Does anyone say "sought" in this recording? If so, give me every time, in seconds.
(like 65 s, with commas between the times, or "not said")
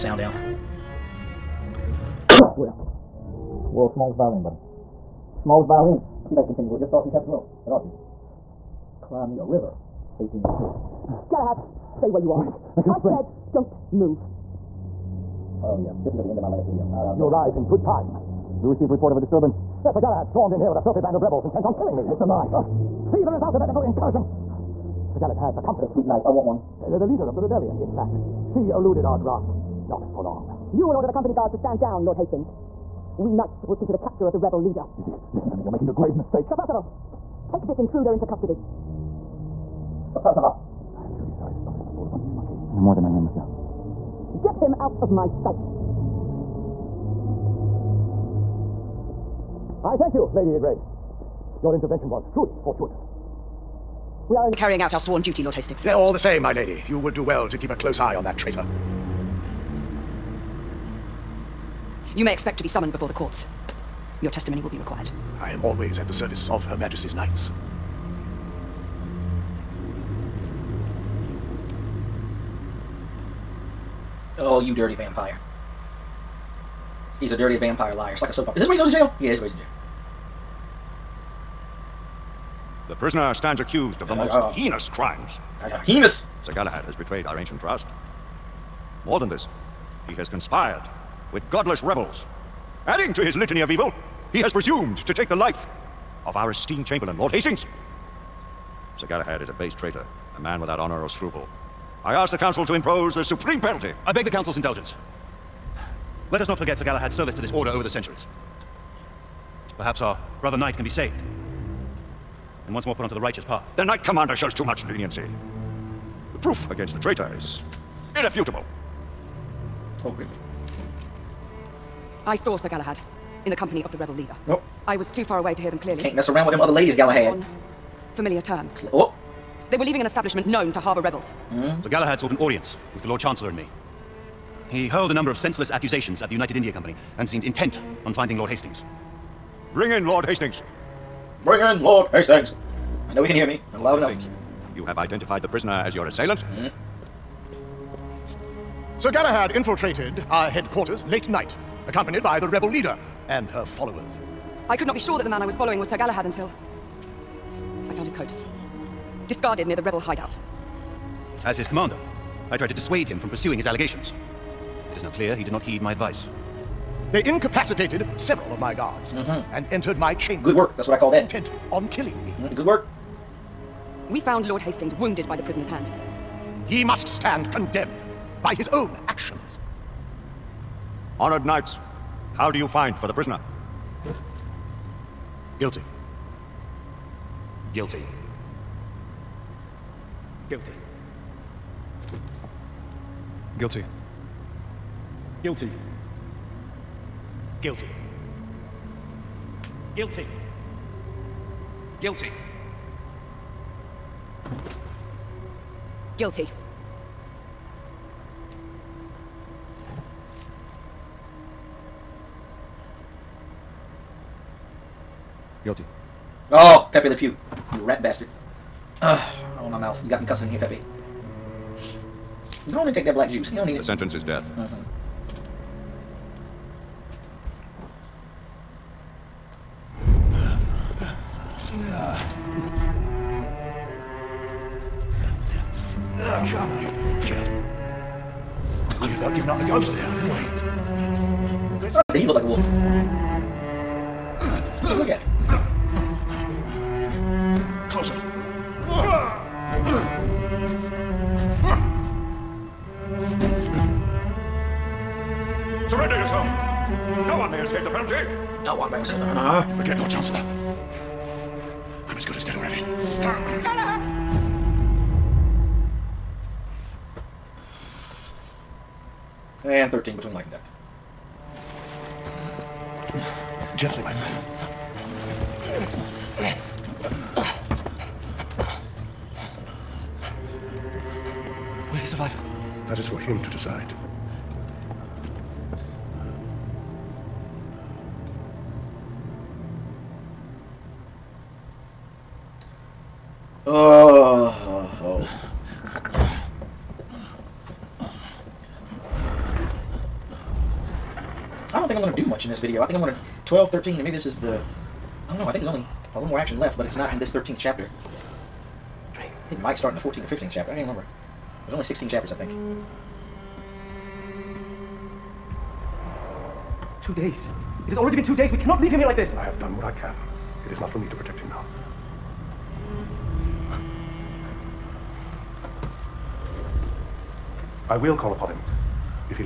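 132 s.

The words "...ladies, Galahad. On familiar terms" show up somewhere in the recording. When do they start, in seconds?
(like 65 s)
126 s.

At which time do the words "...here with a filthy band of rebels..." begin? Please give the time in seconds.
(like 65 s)
20 s.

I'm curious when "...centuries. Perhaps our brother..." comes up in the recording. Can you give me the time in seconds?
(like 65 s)
107 s.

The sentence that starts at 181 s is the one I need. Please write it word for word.
Honored knights, how do you find for the prisoner?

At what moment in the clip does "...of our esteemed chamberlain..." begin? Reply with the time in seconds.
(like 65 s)
96 s.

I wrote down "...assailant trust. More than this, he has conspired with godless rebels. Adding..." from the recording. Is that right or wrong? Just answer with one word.
wrong.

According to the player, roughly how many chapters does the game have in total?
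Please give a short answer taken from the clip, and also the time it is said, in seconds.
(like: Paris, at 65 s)
16, at 311 s.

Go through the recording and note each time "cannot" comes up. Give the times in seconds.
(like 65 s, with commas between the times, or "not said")
318 s.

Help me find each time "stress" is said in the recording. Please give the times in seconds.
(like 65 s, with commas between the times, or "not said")
not said.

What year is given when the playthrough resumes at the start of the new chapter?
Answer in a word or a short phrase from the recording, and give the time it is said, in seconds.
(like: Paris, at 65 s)
1886, at 10 s.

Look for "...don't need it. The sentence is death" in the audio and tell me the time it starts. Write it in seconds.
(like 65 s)
223 s.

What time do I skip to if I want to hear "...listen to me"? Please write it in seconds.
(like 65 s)
35 s.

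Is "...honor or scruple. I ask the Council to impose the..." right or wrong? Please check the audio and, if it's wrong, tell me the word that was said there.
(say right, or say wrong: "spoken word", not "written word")
right.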